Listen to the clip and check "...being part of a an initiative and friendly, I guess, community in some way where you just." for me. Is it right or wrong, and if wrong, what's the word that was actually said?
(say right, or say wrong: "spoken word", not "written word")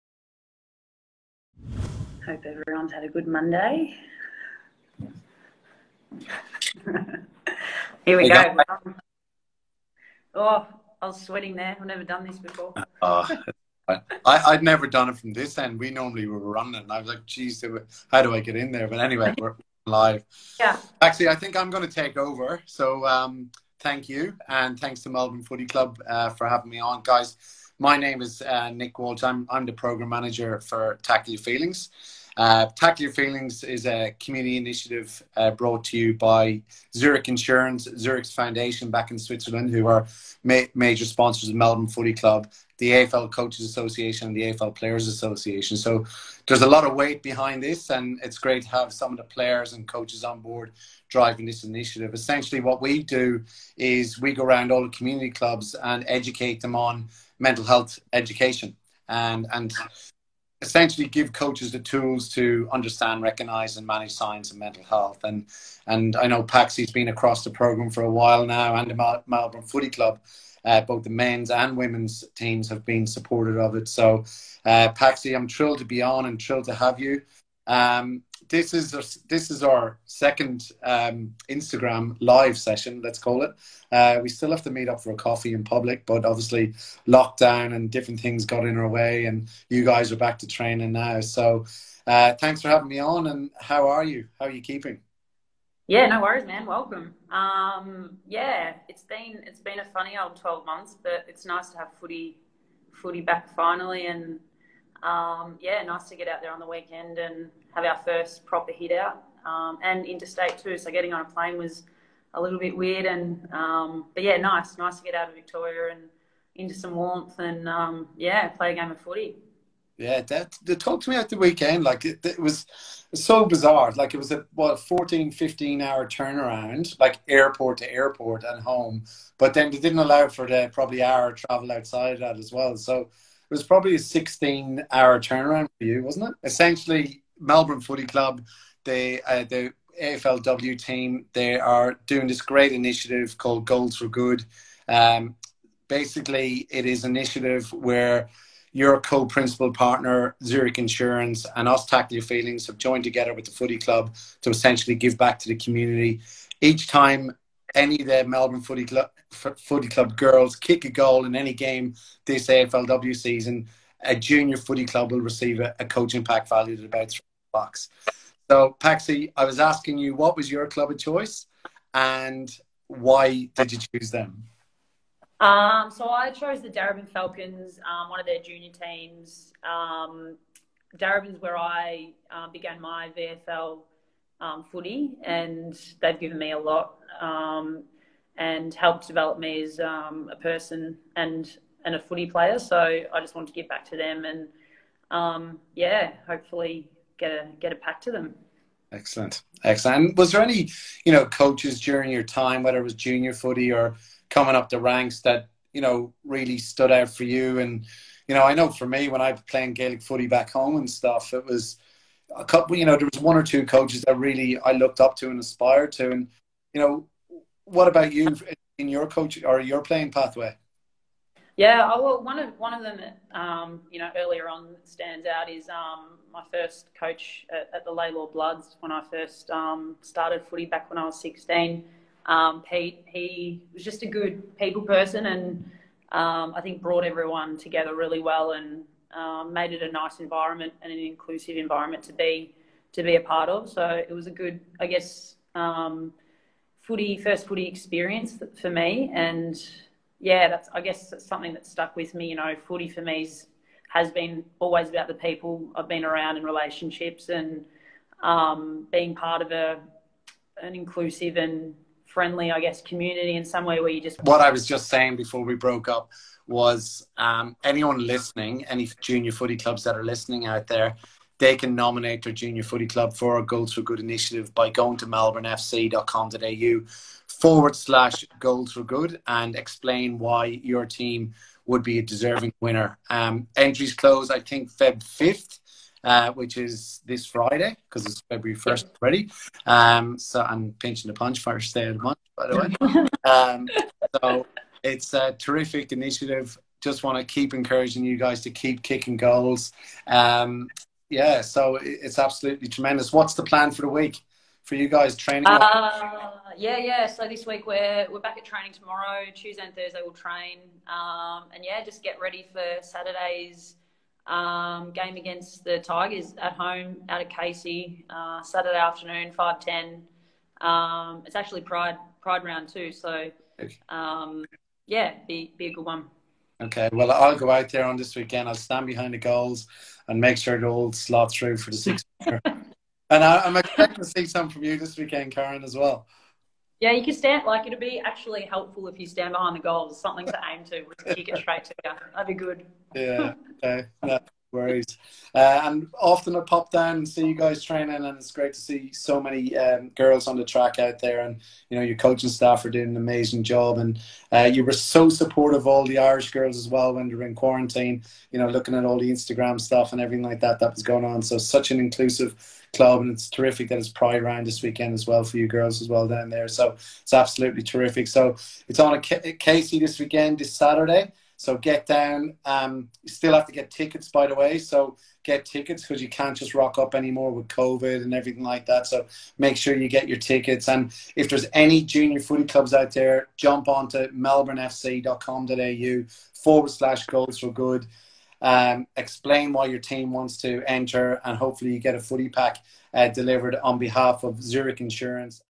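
wrong: "inclusive", not "initiative".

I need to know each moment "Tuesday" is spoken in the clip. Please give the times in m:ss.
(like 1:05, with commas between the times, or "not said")
5:09.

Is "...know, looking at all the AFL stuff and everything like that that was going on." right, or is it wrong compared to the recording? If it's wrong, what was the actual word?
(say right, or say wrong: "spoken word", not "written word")
wrong: "Instagram", not "AFL".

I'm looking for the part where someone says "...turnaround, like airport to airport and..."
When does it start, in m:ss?
2:06.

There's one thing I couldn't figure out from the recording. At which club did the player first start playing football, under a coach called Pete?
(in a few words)
Lalor Bloods.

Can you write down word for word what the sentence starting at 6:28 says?
Um, explain why your team wants to enter, and hopefully you get a footy pack uh, delivered on behalf of Zurich Insurance.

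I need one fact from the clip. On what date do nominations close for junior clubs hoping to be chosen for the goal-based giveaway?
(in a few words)
Feb 5th.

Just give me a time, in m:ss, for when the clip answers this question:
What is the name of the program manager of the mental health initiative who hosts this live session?
0:28.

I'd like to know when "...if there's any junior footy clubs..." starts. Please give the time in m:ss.
6:21.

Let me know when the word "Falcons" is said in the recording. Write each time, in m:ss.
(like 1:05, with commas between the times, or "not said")
2:57.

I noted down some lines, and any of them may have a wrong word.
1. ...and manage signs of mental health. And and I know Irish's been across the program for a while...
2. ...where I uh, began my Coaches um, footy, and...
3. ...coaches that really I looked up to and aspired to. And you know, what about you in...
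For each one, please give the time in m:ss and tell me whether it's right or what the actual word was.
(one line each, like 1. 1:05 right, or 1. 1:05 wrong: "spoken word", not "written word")
1. 1:03 wrong: "Paxi", not "Irish"
2. 3:01 wrong: "VFL", not "Coaches"
3. 3:33 right.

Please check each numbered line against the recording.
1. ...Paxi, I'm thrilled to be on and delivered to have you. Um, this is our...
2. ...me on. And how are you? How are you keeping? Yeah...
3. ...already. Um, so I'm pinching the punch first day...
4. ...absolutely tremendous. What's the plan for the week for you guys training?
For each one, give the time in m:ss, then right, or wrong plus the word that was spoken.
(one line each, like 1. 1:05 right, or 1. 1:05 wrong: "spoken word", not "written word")
1. 1:14 wrong: "thrilled", not "delivered"
2. 1:32 right
3. 4:48 right
4. 5:02 right.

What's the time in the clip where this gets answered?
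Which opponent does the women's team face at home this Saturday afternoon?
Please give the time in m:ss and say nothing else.
5:15.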